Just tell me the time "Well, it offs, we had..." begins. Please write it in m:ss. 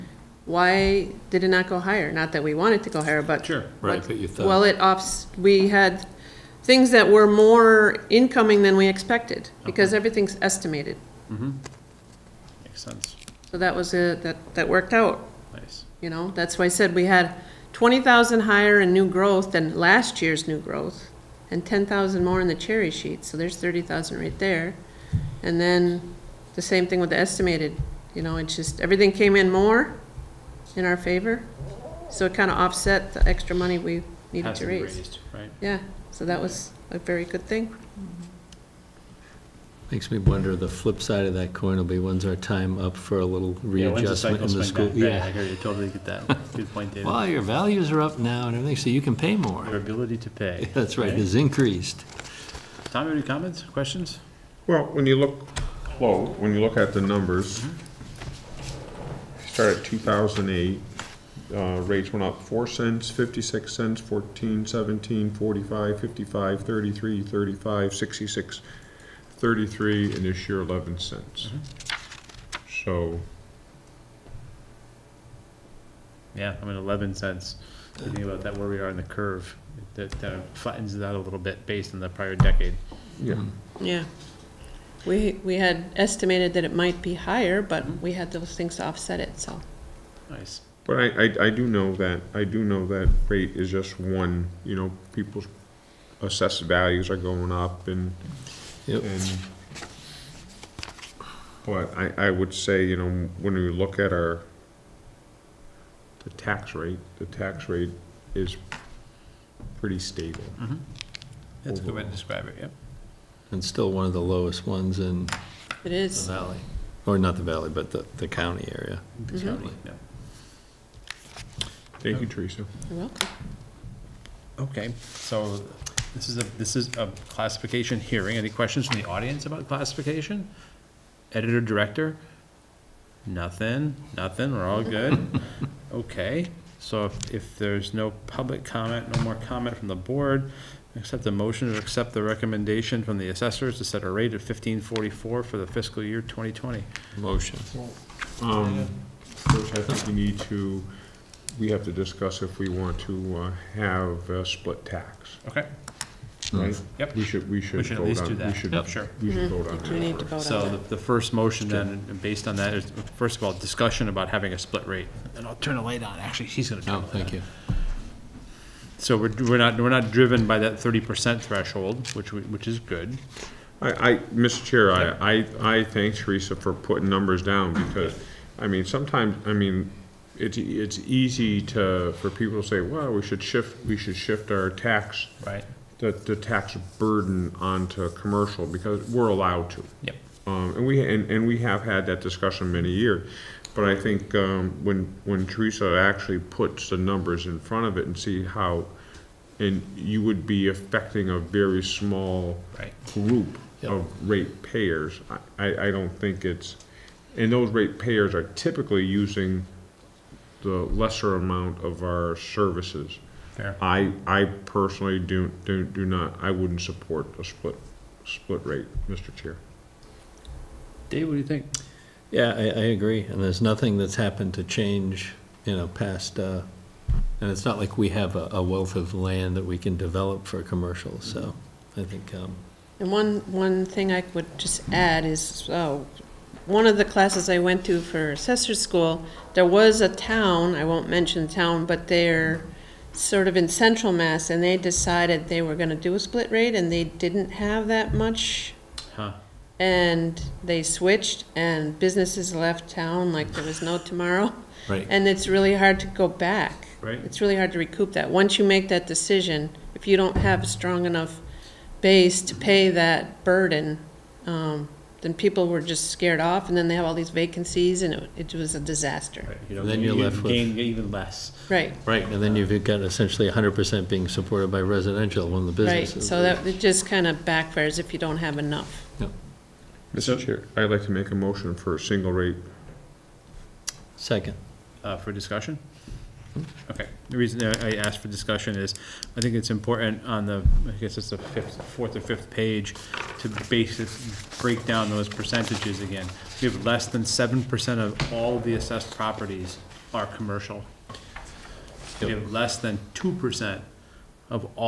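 0:04.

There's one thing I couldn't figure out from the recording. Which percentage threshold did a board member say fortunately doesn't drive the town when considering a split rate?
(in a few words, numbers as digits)
30%.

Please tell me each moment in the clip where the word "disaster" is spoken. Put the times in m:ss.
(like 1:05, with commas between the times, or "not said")
4:28.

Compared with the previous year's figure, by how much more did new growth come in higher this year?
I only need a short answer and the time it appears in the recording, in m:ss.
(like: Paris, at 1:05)
$20,000, at 0:17.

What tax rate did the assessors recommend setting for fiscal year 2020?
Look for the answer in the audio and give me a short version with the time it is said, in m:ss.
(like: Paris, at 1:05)
15.44, at 2:24.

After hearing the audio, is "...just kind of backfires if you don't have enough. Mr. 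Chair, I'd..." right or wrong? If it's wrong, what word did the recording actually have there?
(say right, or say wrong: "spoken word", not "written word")
right.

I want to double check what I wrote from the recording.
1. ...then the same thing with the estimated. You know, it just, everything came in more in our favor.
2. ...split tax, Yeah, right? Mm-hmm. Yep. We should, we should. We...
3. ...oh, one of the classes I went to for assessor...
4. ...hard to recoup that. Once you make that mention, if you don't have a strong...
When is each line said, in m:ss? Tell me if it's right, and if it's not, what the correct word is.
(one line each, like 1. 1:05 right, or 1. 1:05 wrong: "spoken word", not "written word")
1. 0:25 right
2. 2:34 wrong: "Okay", not "Yeah"
3. 3:55 right
4. 4:17 wrong: "decision", not "mention".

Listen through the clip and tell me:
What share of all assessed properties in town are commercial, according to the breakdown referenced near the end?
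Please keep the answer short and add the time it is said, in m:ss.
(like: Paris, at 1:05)
less than 7%, at 4:56.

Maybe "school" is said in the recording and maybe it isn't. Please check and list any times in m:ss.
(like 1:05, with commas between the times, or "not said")
0:44, 3:58.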